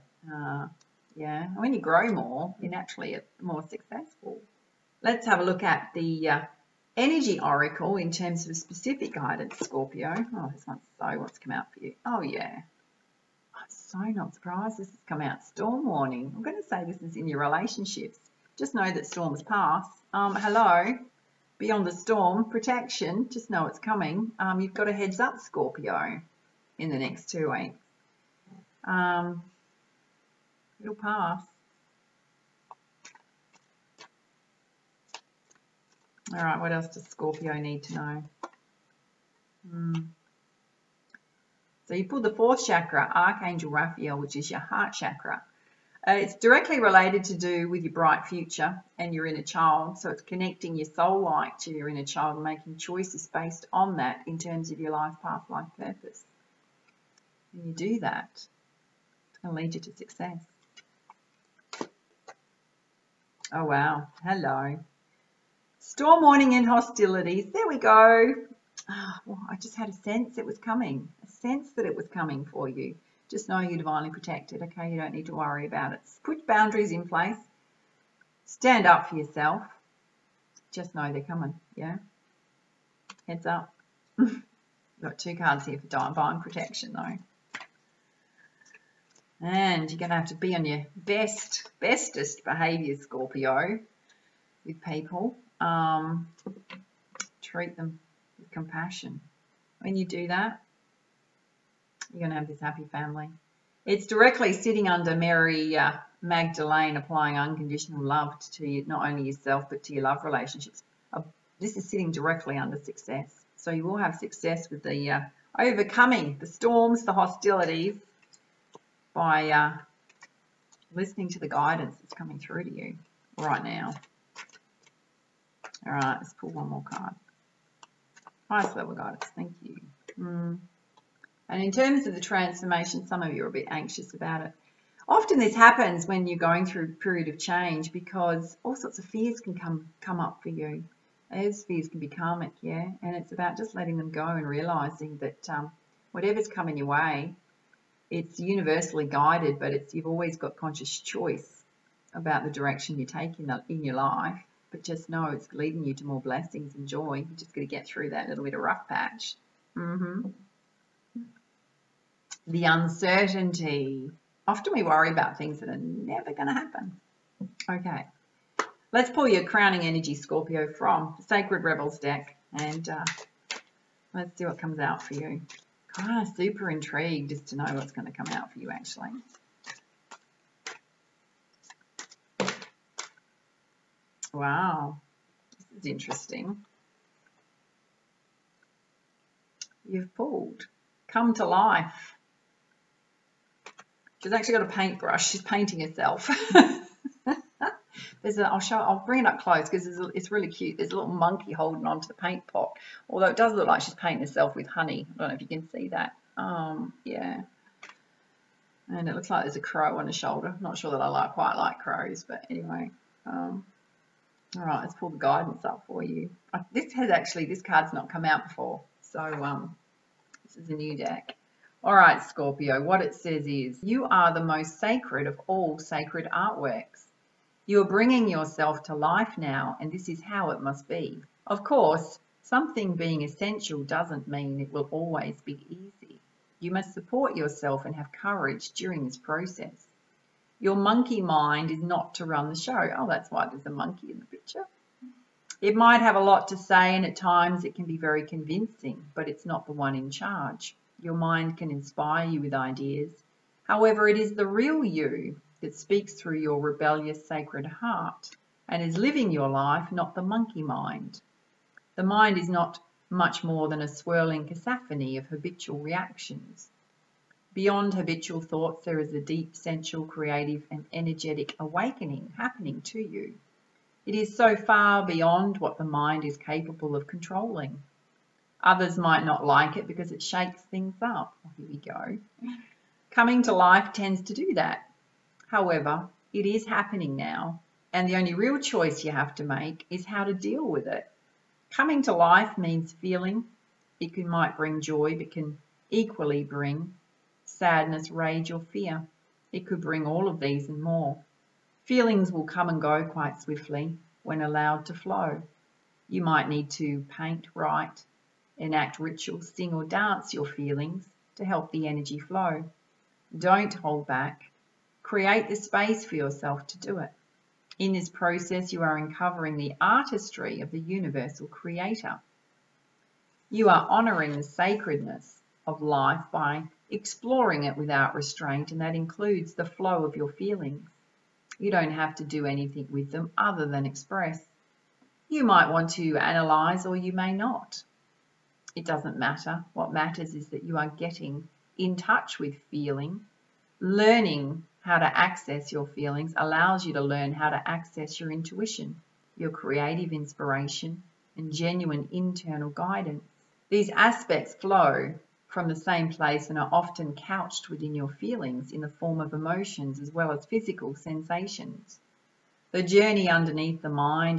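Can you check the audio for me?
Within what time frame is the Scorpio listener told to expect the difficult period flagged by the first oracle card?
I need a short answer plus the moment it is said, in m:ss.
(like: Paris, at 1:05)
Next two weeks, at 0:26.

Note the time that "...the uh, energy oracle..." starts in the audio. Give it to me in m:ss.
0:05.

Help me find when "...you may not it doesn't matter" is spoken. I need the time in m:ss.
5:36.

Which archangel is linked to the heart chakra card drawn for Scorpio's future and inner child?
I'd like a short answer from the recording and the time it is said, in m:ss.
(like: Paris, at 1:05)
Archangel Raphael, at 0:43.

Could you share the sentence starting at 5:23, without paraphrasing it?
You are honoring the sacredness of life by exploring it without restraint, and that includes the flow of your feelings.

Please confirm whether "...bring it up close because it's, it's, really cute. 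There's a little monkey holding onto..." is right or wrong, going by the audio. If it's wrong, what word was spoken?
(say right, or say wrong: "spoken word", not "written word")
right.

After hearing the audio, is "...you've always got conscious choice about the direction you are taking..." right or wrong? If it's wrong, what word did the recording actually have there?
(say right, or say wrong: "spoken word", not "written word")
right.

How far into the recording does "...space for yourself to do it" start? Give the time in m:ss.
5:15.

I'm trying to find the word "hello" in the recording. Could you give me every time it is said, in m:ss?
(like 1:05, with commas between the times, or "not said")
0:20, 1:04.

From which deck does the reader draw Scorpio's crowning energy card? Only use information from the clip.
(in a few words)
Sacred Rebels.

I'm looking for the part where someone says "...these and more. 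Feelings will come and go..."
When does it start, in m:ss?
5:00.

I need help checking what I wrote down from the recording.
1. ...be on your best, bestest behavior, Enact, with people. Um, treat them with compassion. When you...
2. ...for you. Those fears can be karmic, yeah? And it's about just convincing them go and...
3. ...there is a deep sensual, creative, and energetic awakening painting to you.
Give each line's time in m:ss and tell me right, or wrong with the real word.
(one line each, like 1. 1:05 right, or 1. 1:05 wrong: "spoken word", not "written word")
1. 1:30 wrong: "Scorpio", not "Enact"
2. 2:20 wrong: "letting", not "convincing"
3. 4:28 wrong: "happening", not "painting".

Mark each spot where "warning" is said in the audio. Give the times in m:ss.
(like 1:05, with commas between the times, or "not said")
0:15, 1:06.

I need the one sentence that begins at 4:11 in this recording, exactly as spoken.
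Your mind can inspire you with ideas.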